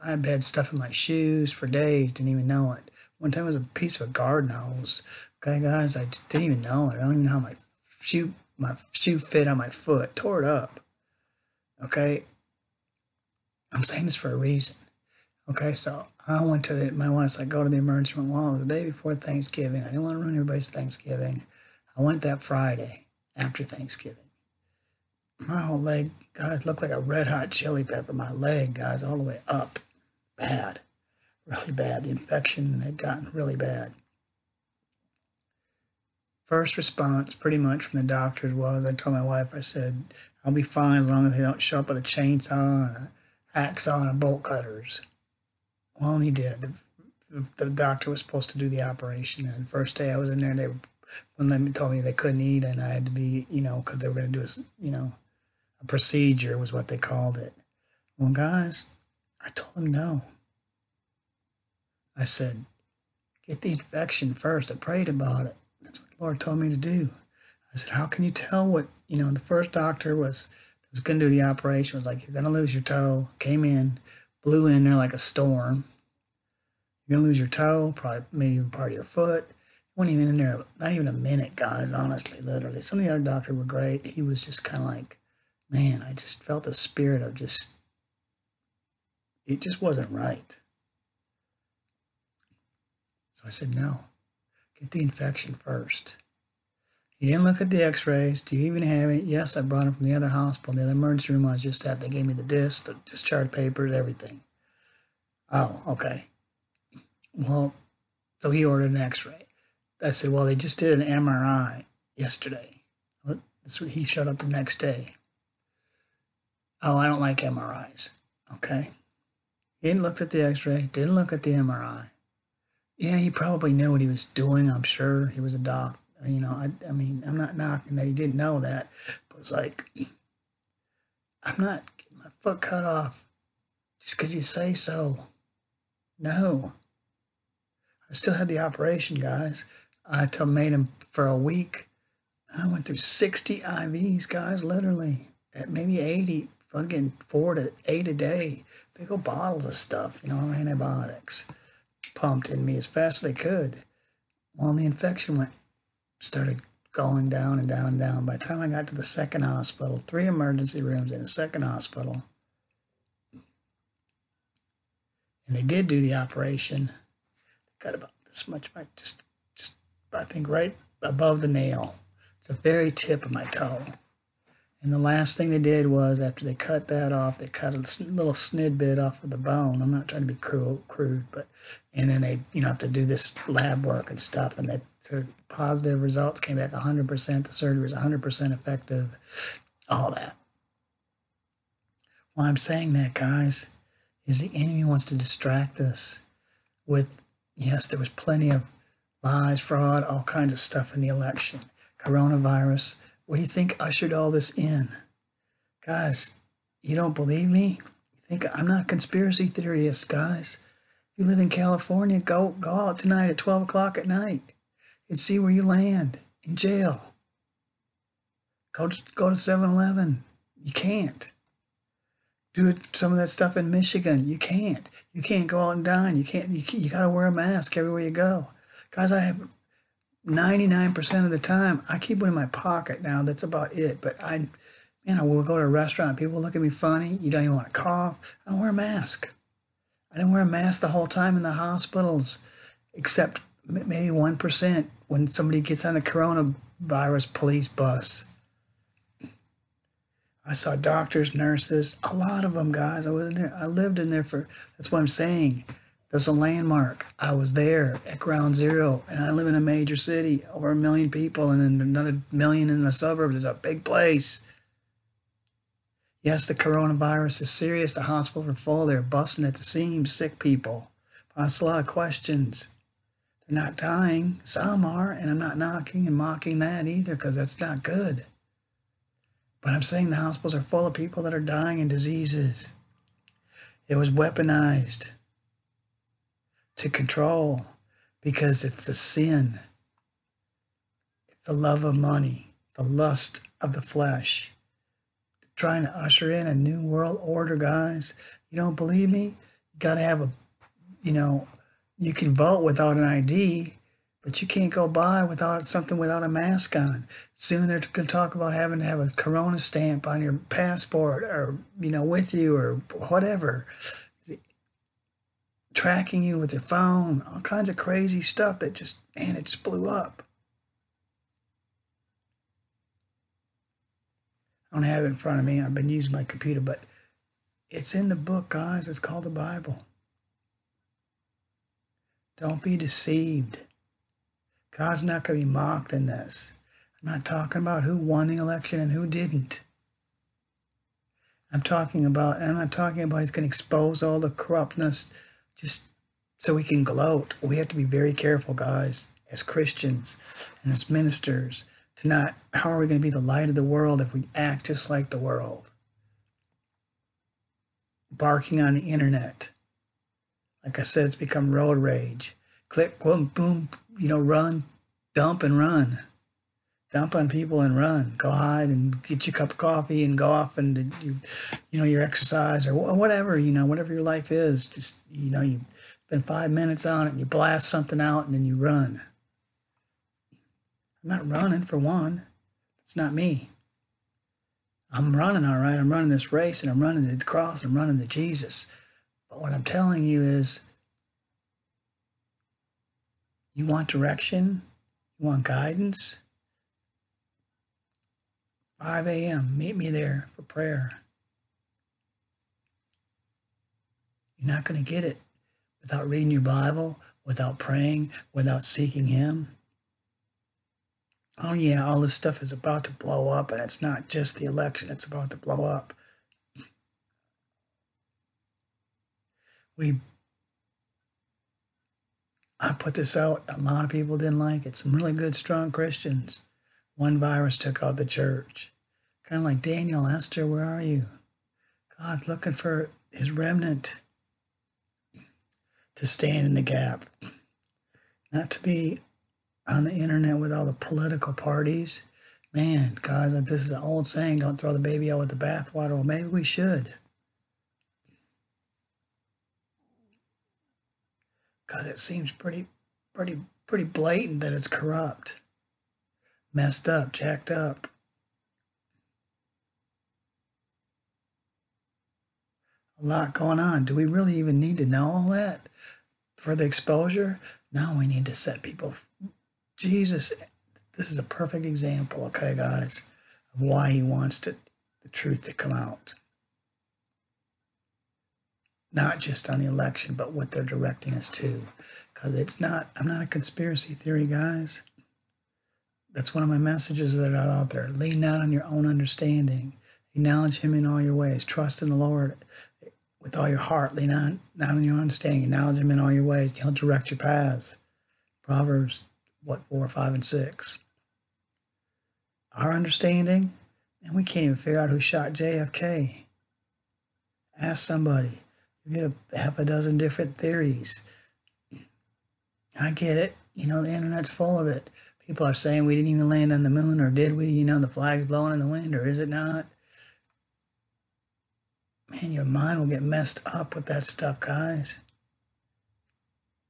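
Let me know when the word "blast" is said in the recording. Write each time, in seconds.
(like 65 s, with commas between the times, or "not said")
377 s.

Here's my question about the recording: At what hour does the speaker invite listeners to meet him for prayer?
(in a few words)
5 a.m.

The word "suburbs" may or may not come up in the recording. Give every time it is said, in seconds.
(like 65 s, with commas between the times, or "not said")
262 s.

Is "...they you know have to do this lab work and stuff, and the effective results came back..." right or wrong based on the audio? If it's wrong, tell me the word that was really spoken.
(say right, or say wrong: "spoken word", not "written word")
wrong: "positive", not "effective".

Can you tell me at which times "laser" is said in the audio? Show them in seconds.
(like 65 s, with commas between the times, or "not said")
not said.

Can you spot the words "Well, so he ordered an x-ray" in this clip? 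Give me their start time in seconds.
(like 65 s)
107 s.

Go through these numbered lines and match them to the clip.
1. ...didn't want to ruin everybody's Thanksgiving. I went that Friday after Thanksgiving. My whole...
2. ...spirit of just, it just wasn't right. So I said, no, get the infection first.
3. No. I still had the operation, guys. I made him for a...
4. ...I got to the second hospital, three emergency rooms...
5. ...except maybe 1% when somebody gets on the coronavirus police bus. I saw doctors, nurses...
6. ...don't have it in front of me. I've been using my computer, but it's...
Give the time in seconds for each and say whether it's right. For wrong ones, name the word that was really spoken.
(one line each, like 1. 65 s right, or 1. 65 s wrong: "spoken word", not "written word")
1. 19 s right
2. 86 s right
3. 136 s right
4. 158 s right
5. 242 s right
6. 324 s right.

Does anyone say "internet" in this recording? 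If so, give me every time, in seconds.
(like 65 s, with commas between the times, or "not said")
358 s, 439 s, 513 s.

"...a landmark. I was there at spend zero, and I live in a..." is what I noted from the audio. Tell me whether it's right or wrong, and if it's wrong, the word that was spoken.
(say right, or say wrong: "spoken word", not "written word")
wrong: "ground", not "spend".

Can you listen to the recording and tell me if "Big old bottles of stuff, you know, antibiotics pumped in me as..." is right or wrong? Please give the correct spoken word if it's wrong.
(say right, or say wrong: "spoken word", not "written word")
right.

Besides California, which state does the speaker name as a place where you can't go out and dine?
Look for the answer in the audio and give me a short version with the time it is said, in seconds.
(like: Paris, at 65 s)
Michigan, at 223 s.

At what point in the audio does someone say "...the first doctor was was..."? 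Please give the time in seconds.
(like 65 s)
69 s.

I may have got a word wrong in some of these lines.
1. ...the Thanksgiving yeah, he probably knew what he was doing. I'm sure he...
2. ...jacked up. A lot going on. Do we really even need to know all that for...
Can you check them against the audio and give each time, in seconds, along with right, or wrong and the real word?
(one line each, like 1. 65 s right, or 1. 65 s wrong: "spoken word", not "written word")
1. 121 s wrong: "MRI", not "Thanksgiving"
2. 457 s right.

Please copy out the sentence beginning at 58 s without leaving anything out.
Well, guys, I told them no.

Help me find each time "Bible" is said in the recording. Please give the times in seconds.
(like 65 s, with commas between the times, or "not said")
329 s, 406 s.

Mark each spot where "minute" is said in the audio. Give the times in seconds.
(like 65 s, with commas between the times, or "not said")
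81 s, 376 s.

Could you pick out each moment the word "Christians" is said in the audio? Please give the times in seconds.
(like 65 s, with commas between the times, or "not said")
349 s, 425 s.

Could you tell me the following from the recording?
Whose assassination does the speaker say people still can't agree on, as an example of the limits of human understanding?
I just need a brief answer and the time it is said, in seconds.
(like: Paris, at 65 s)
JFK, at 505 s.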